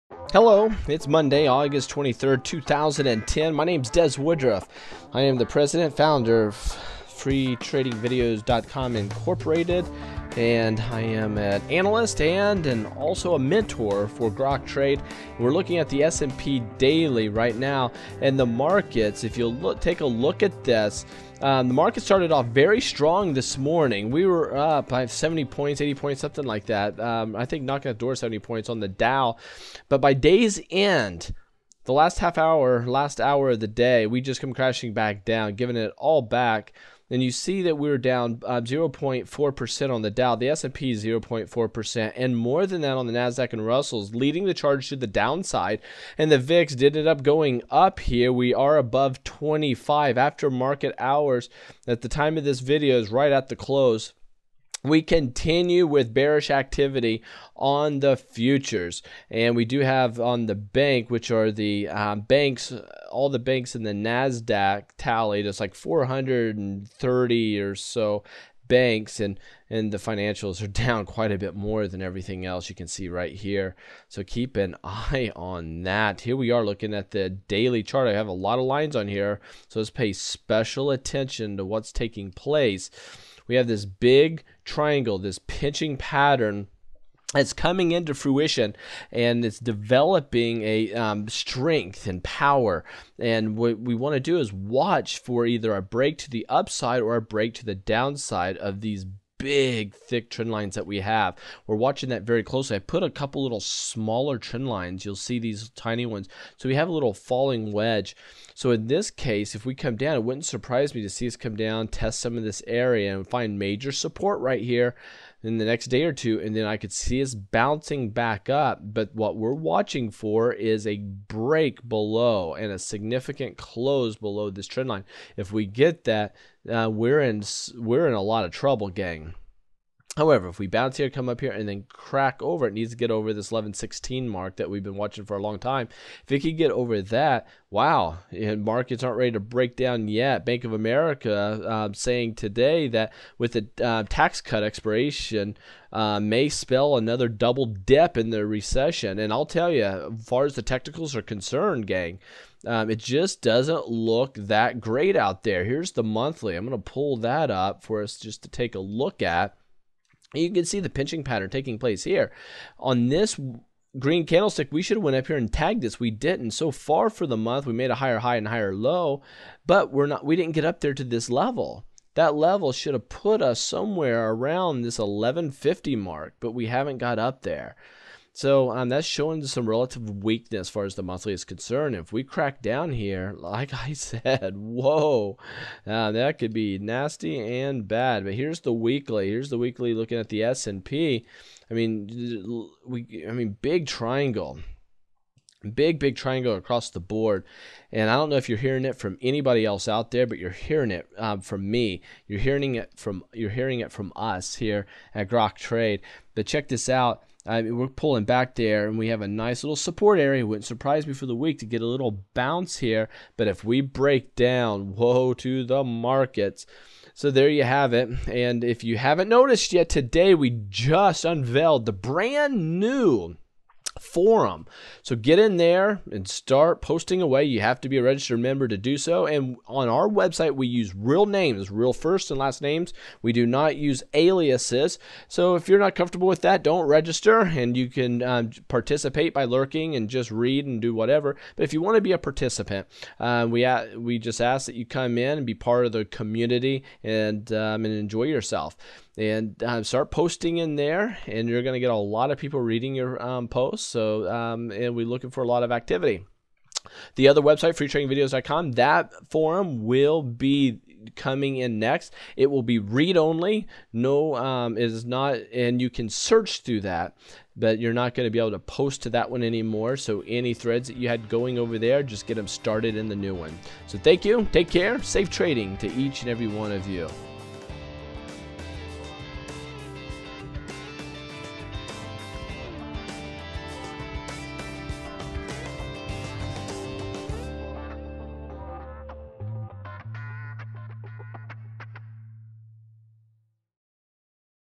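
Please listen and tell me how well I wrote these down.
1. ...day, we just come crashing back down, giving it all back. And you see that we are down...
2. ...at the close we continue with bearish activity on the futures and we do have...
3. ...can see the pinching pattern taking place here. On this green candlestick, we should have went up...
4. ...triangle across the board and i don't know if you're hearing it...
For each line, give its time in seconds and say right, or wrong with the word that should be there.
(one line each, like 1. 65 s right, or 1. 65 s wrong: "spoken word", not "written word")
1. 33 s right
2. 53 s right
3. 160 s right
4. 196 s right.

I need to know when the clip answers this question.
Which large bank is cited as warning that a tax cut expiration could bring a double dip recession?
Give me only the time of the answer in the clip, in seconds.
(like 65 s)
140 s.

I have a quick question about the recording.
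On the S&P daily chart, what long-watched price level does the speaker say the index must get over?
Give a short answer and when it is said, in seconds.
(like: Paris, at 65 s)
1116, at 133 s.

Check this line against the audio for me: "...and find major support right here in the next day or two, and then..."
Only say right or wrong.
right.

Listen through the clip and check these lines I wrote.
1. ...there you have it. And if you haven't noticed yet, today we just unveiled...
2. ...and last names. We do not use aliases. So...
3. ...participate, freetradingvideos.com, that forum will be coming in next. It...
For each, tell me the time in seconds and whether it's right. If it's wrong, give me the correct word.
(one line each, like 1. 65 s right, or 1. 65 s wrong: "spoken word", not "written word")
1. 217 s right
2. 232 s right
3. 257 s wrong: "website", not "participate".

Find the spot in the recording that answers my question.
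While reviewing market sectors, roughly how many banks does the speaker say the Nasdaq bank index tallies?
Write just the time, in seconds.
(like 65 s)
65 s.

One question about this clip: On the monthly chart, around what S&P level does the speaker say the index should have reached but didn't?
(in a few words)
1150.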